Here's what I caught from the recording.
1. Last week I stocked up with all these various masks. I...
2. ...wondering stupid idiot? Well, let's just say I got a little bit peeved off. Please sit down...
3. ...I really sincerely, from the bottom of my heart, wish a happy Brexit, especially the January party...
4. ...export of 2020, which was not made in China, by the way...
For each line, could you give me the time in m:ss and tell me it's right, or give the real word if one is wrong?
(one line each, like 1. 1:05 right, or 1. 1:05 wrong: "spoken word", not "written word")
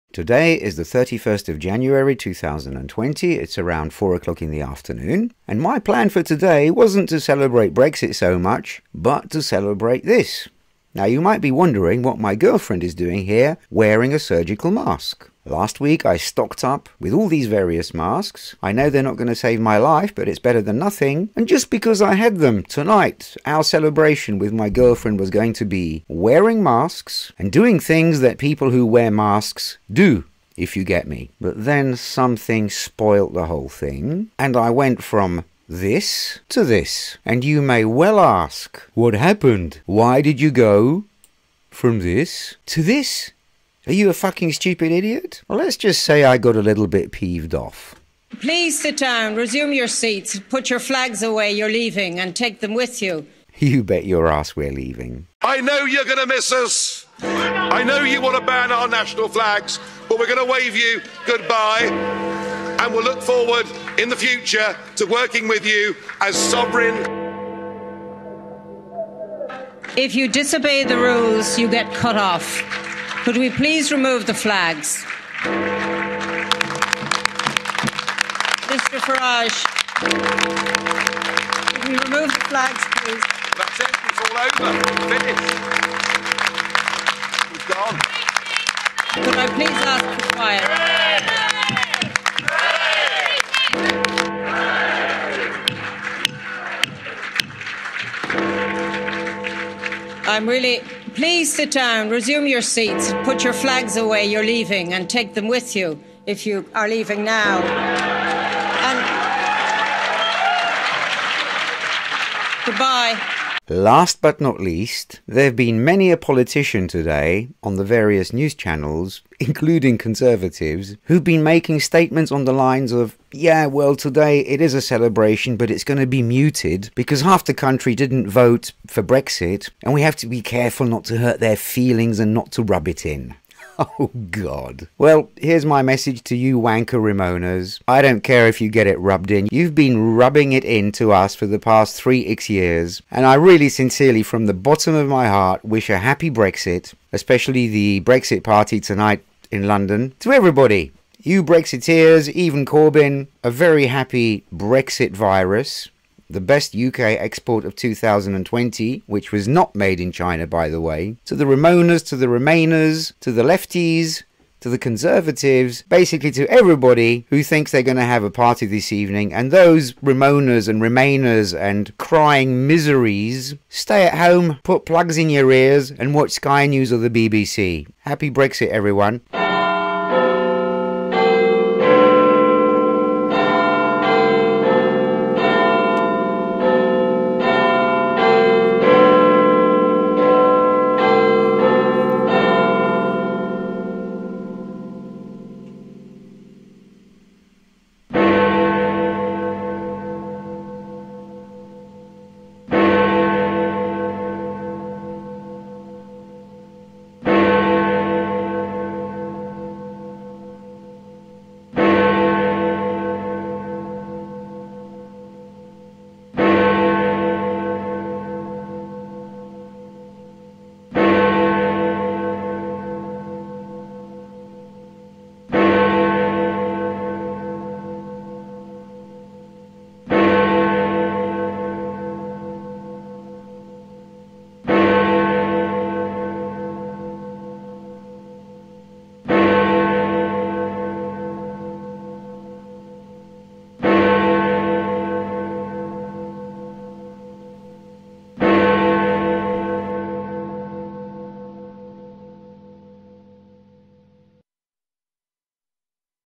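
1. 0:15 right
2. 0:44 wrong: "fucking", not "wondering"
3. 2:23 wrong: "Brexit", not "January"
4. 2:37 right.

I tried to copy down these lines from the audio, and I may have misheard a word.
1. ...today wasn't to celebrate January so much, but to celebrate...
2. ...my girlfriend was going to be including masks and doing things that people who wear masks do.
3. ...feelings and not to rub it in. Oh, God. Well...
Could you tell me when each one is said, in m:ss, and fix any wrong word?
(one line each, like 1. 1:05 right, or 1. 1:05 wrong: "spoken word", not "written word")
1. 0:06 wrong: "Brexit", not "January"
2. 0:24 wrong: "wearing", not "including"
3. 2:11 right.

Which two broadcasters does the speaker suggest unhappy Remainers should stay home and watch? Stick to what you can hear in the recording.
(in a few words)
Sky News or the BBC.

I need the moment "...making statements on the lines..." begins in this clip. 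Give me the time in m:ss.
2:01.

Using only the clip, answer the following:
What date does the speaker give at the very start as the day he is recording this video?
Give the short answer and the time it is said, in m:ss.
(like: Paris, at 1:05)
31st of January 2020, at 0:00.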